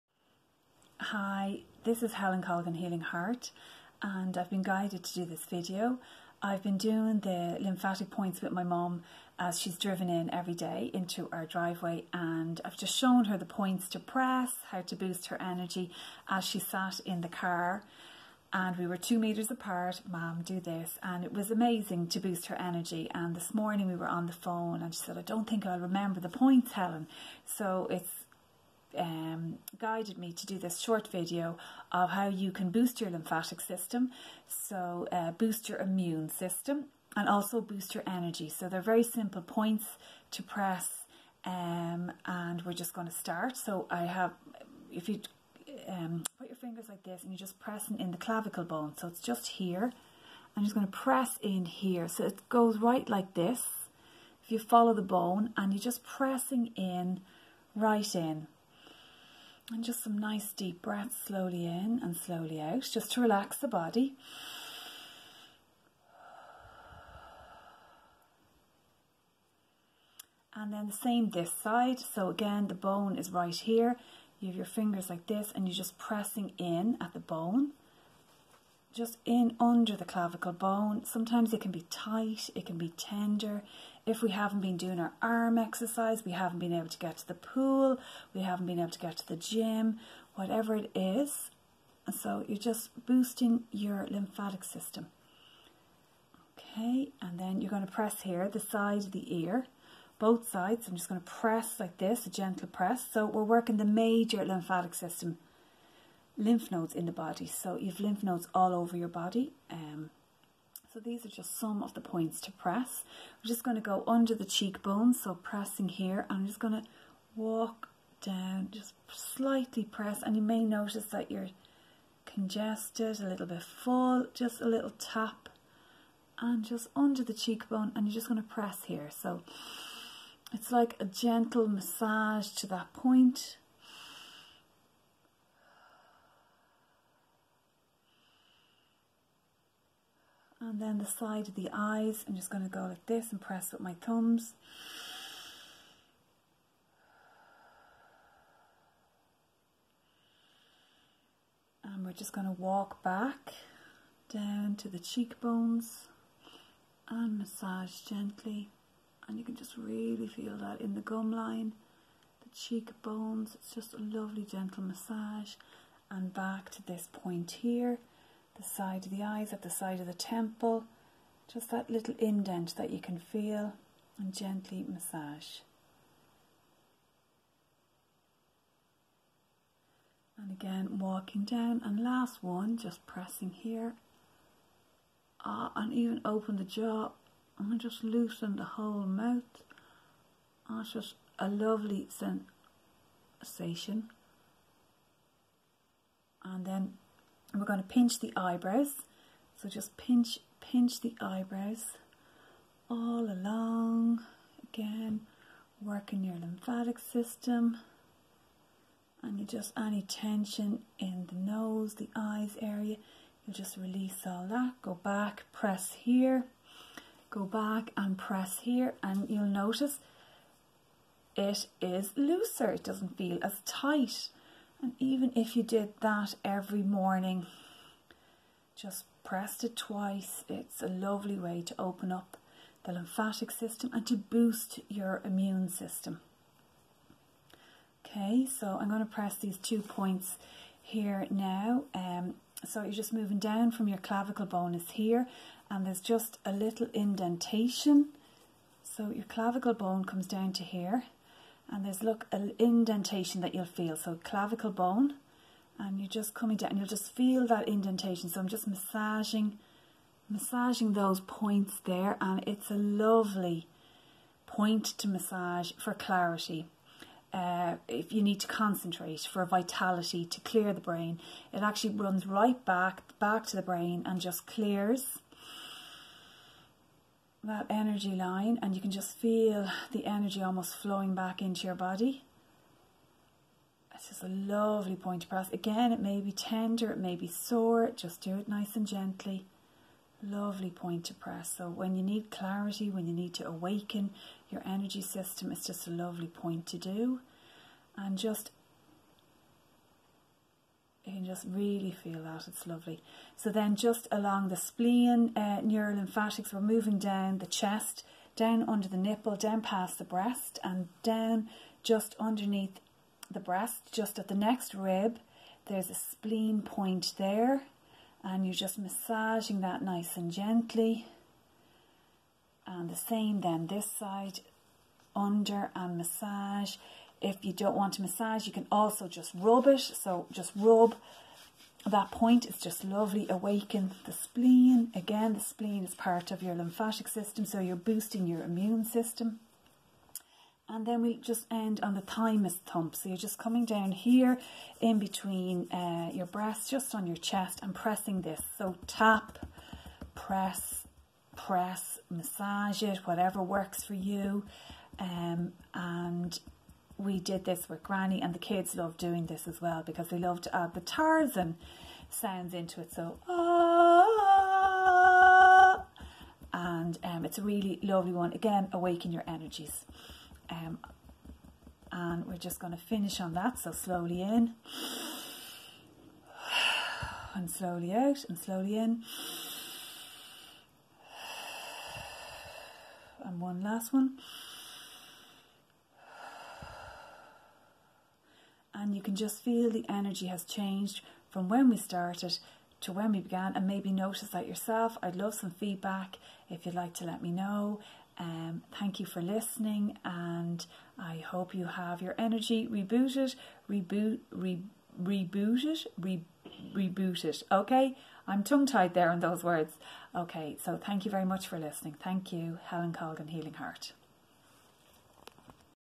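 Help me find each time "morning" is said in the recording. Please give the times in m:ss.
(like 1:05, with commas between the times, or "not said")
0:23, 3:46.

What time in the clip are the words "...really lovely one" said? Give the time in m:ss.
6:07.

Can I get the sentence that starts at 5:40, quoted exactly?
And then we'll just end on the thymus thump.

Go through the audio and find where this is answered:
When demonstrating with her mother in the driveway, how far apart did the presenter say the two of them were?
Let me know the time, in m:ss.
0:18.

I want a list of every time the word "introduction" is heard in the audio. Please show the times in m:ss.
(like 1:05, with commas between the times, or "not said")
not said.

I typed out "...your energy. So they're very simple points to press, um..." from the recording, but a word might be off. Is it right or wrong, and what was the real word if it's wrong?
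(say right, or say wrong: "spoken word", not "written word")
right.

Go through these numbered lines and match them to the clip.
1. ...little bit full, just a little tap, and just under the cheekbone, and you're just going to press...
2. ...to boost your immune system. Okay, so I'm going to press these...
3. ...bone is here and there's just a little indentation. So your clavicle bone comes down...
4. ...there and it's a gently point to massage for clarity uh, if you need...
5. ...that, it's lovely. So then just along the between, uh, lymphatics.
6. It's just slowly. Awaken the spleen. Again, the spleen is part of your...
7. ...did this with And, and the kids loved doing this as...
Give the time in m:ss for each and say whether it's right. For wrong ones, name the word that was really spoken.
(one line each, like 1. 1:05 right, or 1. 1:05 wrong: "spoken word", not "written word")
1. 2:03 right
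2. 3:54 right
3. 4:04 right
4. 4:21 wrong: "lovely", not "gently"
5. 5:02 wrong: "spleen", not "between"
6. 5:32 wrong: "lovely", not "slowly"
7. 5:57 wrong: "Granny", not "And".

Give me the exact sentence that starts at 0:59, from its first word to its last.
And just some nice deep breaths slowly in and slowly out, just to relax the body.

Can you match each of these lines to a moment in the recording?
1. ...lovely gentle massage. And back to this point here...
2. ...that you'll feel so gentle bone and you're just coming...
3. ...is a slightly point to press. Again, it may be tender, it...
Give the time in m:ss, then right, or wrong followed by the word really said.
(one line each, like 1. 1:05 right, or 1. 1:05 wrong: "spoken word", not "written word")
1. 2:43 right
2. 4:13 wrong: "clavicle", not "gentle"
3. 4:44 wrong: "lovely", not "slightly".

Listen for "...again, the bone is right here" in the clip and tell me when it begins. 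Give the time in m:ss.
1:12.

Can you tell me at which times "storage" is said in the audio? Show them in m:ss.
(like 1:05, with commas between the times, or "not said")
not said.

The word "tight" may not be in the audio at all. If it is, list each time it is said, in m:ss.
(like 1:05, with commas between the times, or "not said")
1:21, 3:43.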